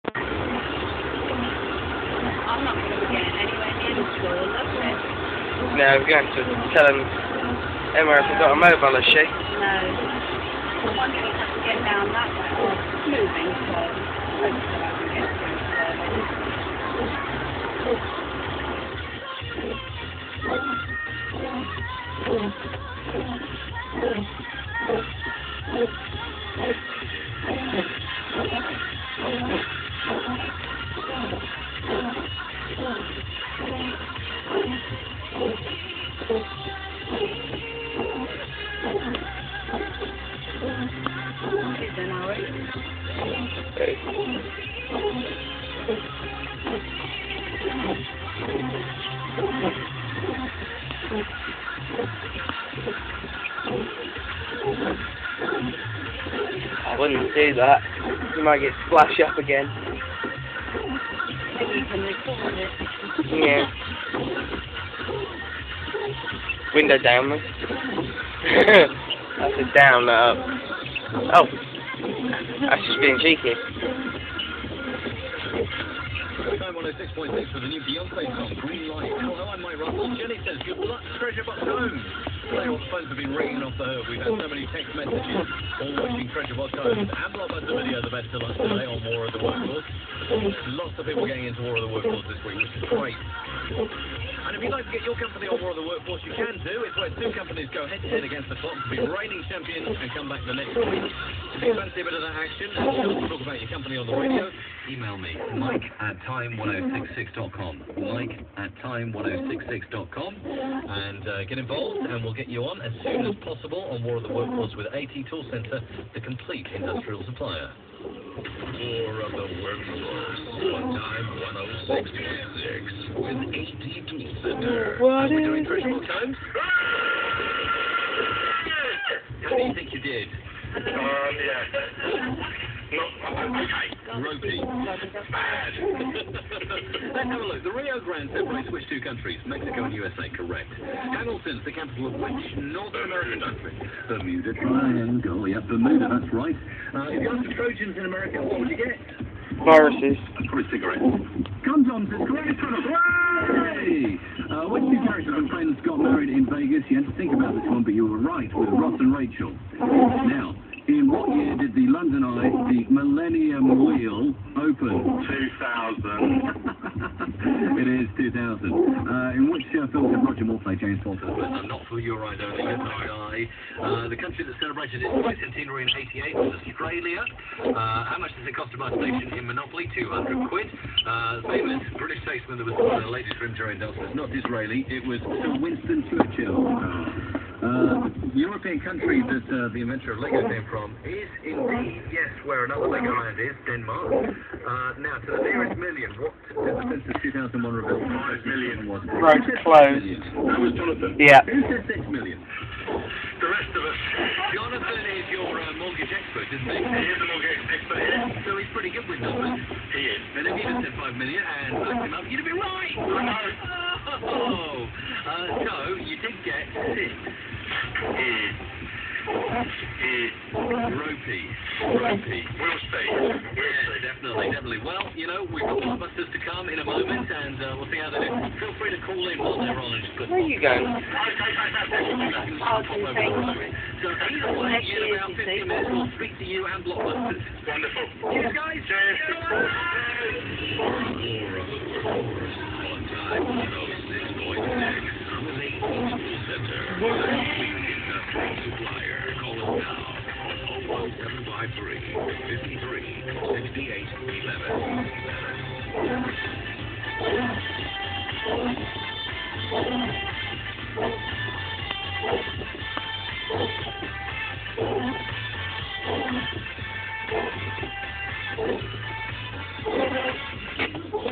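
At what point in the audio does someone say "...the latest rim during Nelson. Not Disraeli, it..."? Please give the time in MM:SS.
03:02.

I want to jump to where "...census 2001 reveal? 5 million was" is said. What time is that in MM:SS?
03:17.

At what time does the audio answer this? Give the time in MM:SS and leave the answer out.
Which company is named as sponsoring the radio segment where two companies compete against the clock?
01:54.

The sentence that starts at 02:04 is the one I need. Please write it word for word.
What Are we doing virtual times?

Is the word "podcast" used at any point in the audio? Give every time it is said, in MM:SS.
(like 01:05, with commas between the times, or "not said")
not said.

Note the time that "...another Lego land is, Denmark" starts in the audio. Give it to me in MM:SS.
03:12.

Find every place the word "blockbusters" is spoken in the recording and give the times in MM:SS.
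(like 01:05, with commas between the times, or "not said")
03:45, 03:56.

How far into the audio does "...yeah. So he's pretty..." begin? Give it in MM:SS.
03:28.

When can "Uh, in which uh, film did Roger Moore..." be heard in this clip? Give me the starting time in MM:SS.
02:48.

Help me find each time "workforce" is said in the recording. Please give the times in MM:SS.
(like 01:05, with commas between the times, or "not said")
01:35, 01:54.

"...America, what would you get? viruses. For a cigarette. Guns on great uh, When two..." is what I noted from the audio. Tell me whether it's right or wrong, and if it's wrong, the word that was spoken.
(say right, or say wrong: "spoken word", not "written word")
right.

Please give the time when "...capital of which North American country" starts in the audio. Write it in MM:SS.
02:21.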